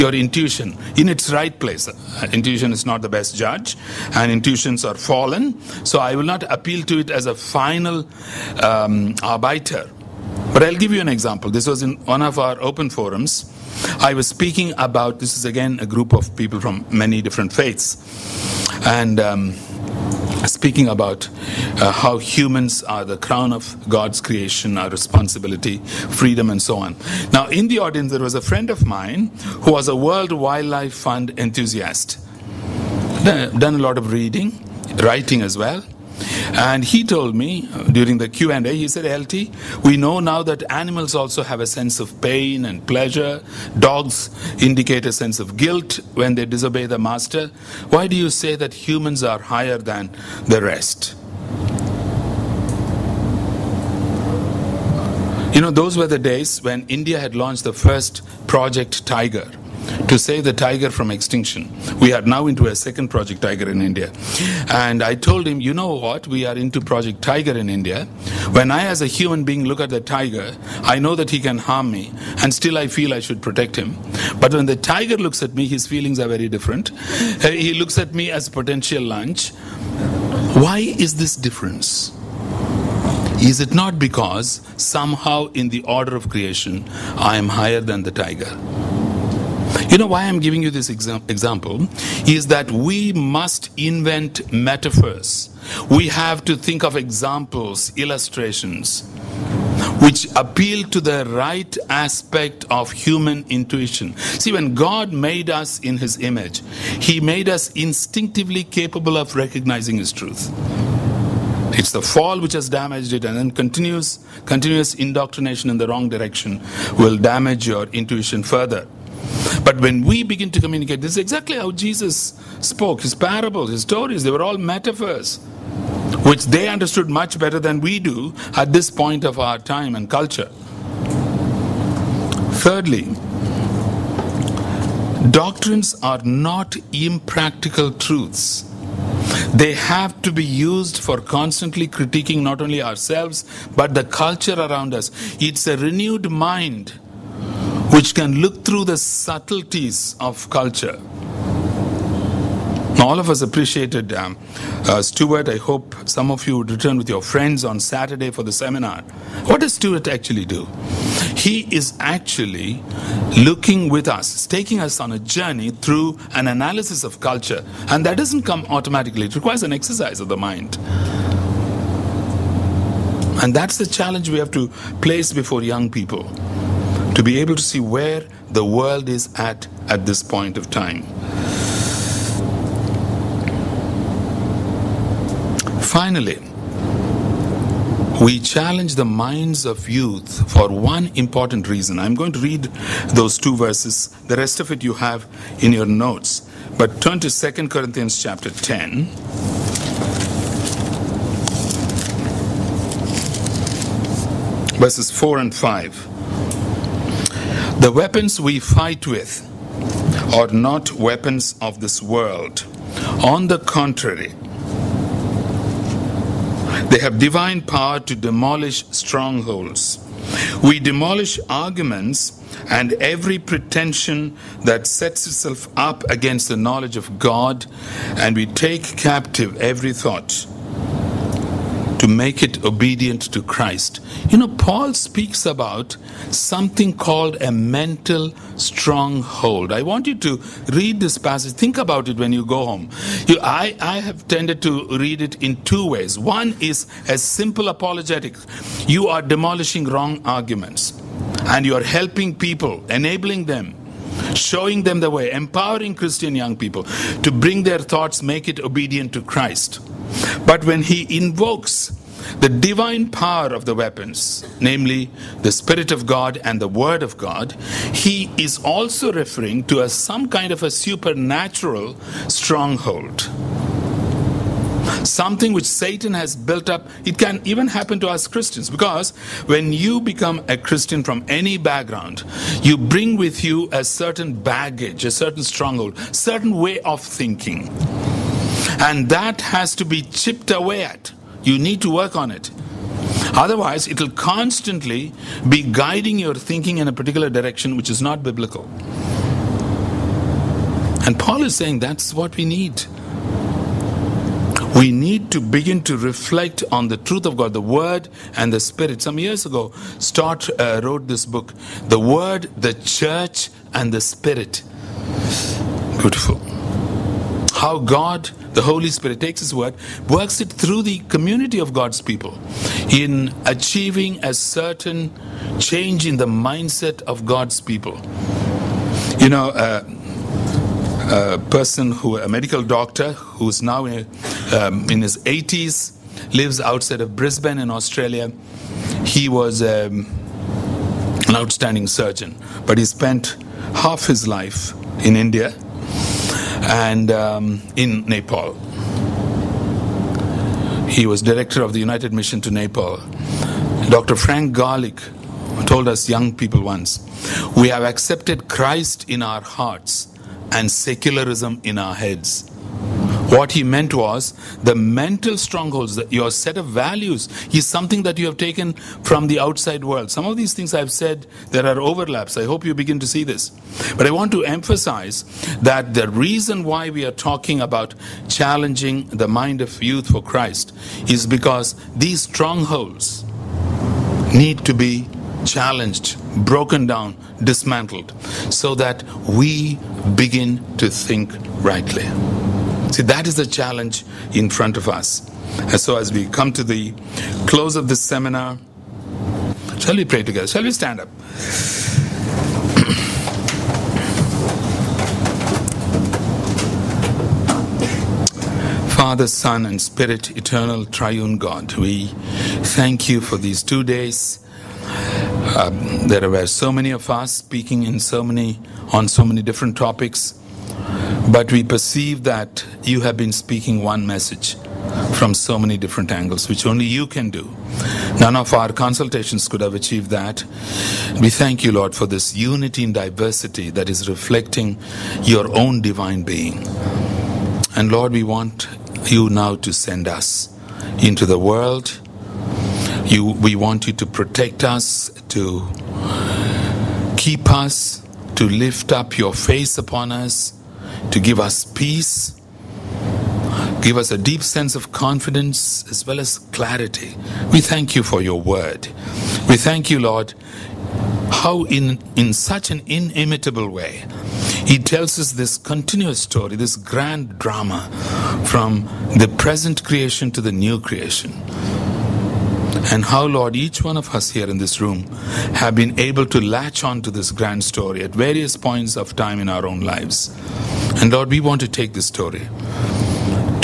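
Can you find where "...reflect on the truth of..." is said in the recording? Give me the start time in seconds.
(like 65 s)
305 s.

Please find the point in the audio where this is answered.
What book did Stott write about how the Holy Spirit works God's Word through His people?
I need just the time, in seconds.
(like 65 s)
311 s.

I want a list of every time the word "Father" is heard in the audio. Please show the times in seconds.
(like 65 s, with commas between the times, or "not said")
408 s.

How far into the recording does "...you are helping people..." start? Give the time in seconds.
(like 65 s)
251 s.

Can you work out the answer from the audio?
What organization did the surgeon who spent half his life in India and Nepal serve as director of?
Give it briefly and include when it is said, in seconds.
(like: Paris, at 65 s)
United Mission to Nepal, at 351 s.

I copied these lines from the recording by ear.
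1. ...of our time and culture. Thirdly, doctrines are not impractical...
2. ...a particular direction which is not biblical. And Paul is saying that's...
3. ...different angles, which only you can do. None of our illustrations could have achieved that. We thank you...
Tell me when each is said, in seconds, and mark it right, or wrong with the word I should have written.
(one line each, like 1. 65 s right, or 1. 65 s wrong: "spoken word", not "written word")
1. 129 s right
2. 296 s right
3. 425 s wrong: "consultations", not "illustrations".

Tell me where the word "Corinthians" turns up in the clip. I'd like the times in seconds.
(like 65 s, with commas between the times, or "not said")
197 s.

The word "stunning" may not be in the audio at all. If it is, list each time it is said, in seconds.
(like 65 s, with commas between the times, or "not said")
not said.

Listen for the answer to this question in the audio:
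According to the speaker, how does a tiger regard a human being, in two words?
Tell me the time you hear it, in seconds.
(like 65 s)
78 s.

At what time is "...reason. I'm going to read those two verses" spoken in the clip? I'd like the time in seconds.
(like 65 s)
191 s.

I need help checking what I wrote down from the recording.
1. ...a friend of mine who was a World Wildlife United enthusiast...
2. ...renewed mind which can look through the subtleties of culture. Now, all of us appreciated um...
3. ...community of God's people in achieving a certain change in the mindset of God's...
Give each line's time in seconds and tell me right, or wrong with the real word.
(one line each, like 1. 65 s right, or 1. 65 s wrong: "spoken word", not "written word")
1. 28 s wrong: "Fund", not "United"
2. 145 s right
3. 320 s right.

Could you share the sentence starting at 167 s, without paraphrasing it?
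And that doesn't come automatically, it requires an exercise of the mind.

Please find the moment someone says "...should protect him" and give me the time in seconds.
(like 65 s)
73 s.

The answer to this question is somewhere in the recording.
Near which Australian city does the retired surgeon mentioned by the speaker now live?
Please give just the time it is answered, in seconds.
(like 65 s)
337 s.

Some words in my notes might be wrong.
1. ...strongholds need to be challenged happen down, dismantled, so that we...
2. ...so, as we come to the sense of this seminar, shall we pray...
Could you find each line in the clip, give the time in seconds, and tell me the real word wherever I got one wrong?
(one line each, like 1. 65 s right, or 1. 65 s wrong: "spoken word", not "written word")
1. 382 s wrong: "broken", not "happen"
2. 395 s wrong: "close", not "sense".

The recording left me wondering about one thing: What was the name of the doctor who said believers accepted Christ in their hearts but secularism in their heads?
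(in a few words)
Frank Garlick.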